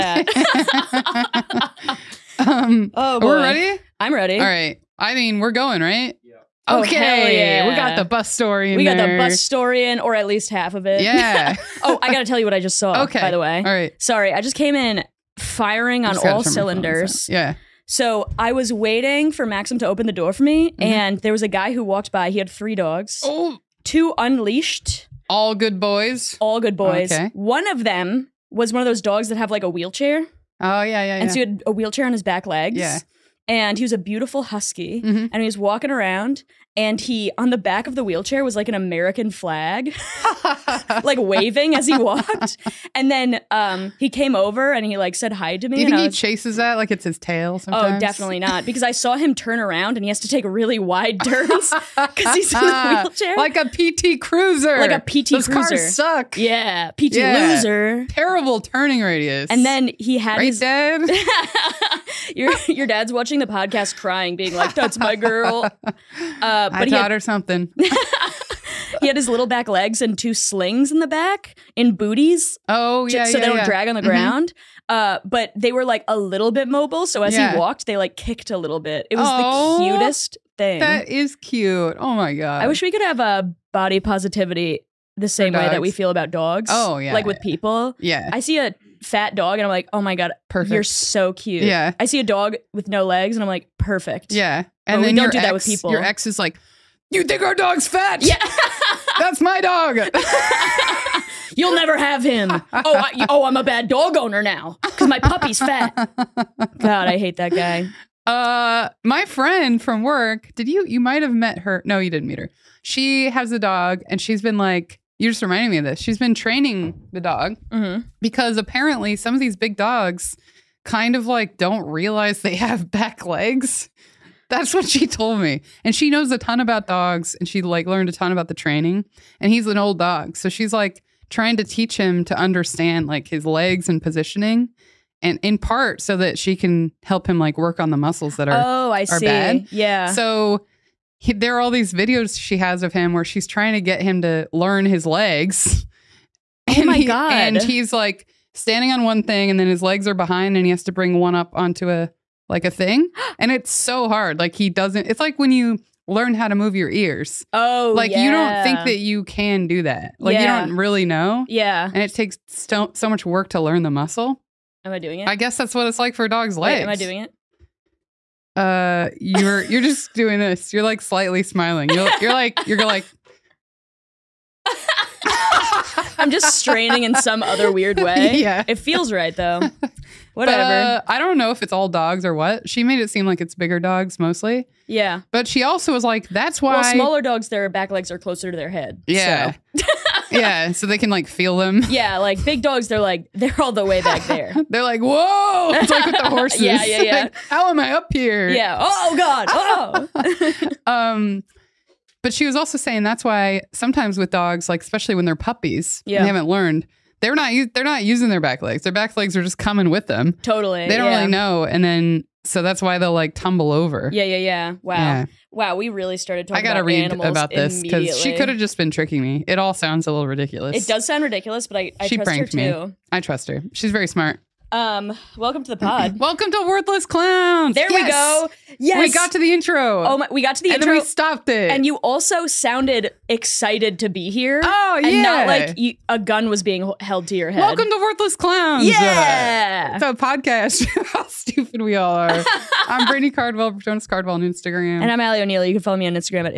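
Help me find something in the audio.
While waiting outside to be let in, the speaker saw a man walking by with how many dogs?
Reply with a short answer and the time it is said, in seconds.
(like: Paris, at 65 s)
3, at 22 s.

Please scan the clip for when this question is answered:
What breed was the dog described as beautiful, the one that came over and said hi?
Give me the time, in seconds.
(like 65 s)
34 s.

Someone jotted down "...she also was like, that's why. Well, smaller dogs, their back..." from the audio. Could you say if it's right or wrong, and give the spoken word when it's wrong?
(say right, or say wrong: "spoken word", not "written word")
right.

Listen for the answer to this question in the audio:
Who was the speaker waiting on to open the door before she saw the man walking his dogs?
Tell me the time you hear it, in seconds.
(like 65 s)
19 s.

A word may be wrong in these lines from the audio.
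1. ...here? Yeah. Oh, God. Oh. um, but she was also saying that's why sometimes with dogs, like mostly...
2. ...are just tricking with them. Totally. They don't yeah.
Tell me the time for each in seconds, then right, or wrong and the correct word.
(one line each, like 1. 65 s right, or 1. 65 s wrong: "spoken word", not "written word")
1. 198 s wrong: "especially", not "mostly"
2. 209 s wrong: "coming", not "tricking".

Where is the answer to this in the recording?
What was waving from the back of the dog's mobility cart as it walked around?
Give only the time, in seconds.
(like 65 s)
38 s.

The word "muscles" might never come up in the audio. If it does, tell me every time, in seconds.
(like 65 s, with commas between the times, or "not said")
137 s, 163 s.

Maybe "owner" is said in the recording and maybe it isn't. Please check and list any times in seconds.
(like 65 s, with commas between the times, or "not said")
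104 s.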